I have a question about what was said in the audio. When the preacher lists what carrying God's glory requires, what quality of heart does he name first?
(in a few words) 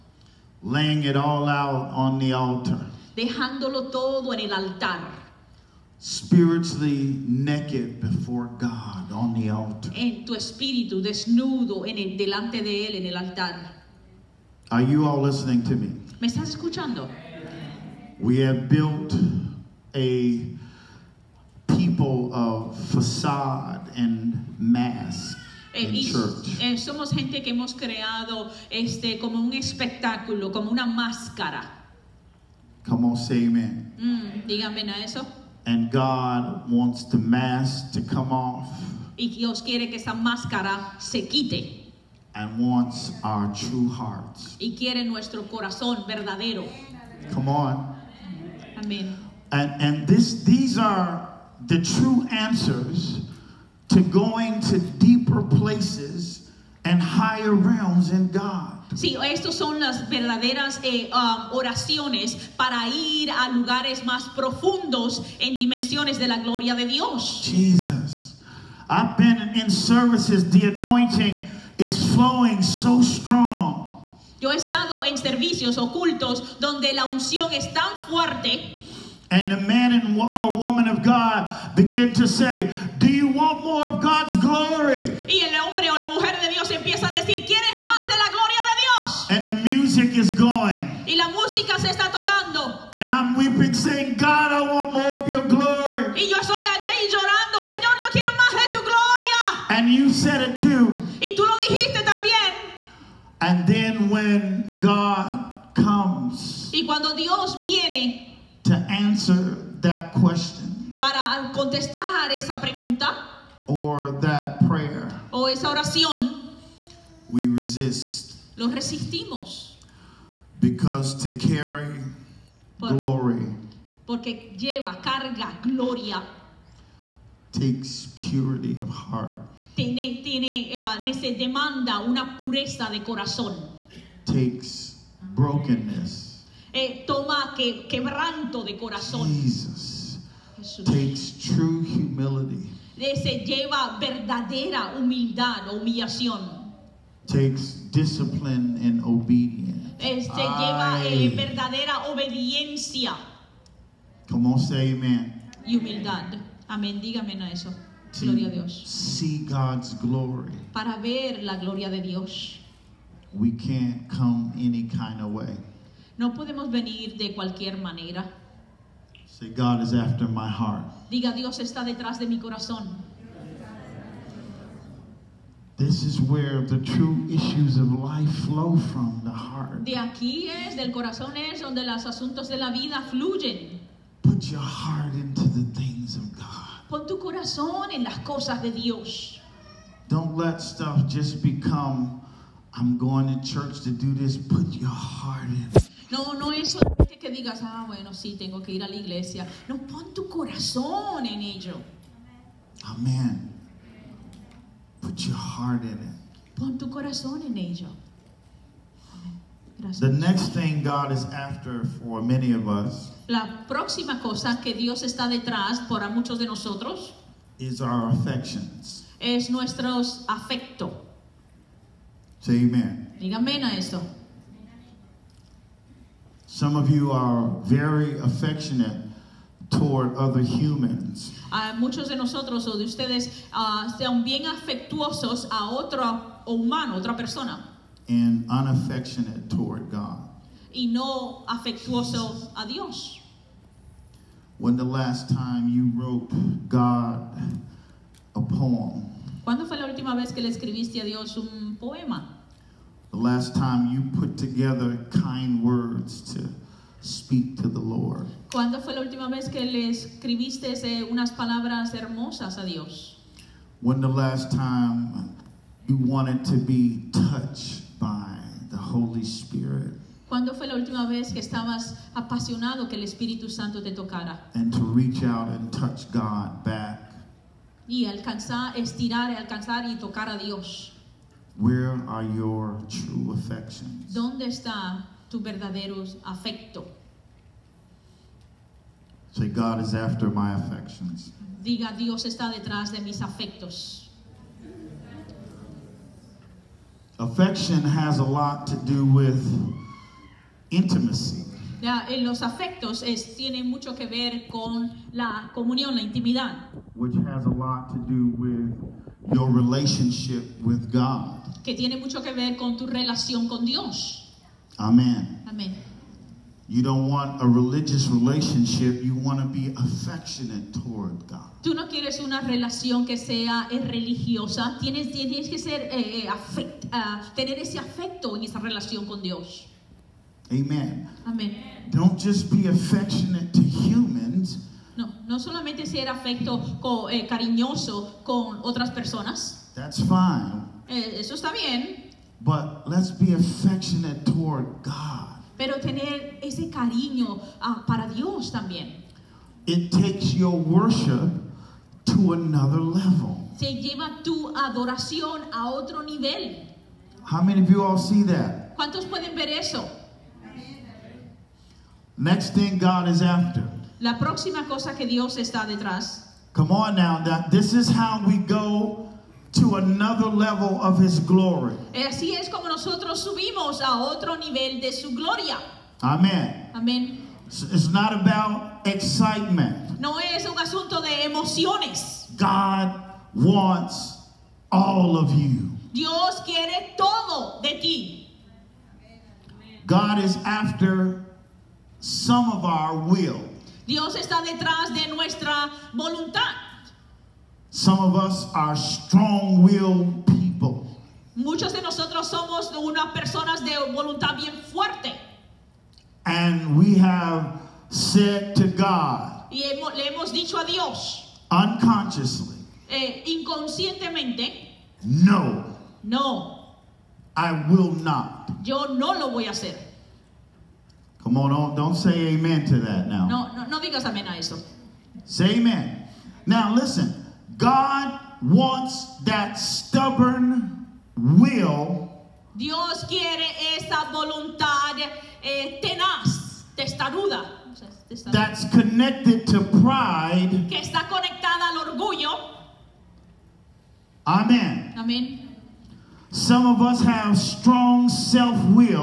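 Purity of heart.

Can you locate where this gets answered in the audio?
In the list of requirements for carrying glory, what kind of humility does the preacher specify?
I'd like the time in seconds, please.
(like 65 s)
141 s.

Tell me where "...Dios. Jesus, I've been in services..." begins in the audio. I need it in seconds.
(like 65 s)
66 s.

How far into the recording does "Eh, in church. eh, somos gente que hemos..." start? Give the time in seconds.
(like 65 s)
25 s.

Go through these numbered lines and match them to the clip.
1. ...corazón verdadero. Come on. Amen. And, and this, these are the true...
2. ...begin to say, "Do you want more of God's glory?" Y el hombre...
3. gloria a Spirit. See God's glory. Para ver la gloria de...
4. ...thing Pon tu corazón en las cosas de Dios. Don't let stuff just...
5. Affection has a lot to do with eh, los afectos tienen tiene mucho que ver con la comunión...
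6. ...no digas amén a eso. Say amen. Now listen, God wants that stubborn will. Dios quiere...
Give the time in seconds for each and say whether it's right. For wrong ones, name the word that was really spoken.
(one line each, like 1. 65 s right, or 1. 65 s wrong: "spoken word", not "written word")
1. 45 s right
2. 81 s right
3. 158 s wrong: "Dios", not "Spirit"
4. 185 s right
5. 297 s right
6. 423 s right.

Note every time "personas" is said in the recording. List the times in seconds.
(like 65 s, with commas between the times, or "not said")
237 s, 338 s, 403 s.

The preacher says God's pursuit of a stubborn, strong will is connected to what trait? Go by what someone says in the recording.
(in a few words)
Pride.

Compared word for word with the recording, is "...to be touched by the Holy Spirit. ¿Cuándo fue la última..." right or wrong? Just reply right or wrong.
right.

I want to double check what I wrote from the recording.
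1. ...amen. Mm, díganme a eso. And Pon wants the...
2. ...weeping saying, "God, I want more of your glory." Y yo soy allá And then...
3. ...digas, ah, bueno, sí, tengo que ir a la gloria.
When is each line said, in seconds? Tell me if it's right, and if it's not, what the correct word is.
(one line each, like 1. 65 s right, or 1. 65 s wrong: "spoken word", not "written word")
1. 33 s wrong: "God", not "Pon"
2. 93 s right
3. 197 s wrong: "iglesia", not "gloria".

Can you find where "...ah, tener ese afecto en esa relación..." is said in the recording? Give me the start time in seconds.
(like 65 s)
326 s.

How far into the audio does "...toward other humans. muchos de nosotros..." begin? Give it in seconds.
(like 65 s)
229 s.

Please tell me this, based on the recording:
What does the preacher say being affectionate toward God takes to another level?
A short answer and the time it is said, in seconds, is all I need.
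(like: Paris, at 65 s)
Your worship, at 350 s.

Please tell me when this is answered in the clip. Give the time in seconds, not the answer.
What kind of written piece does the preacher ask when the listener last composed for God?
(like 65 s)
248 s.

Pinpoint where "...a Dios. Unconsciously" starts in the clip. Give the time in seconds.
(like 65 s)
410 s.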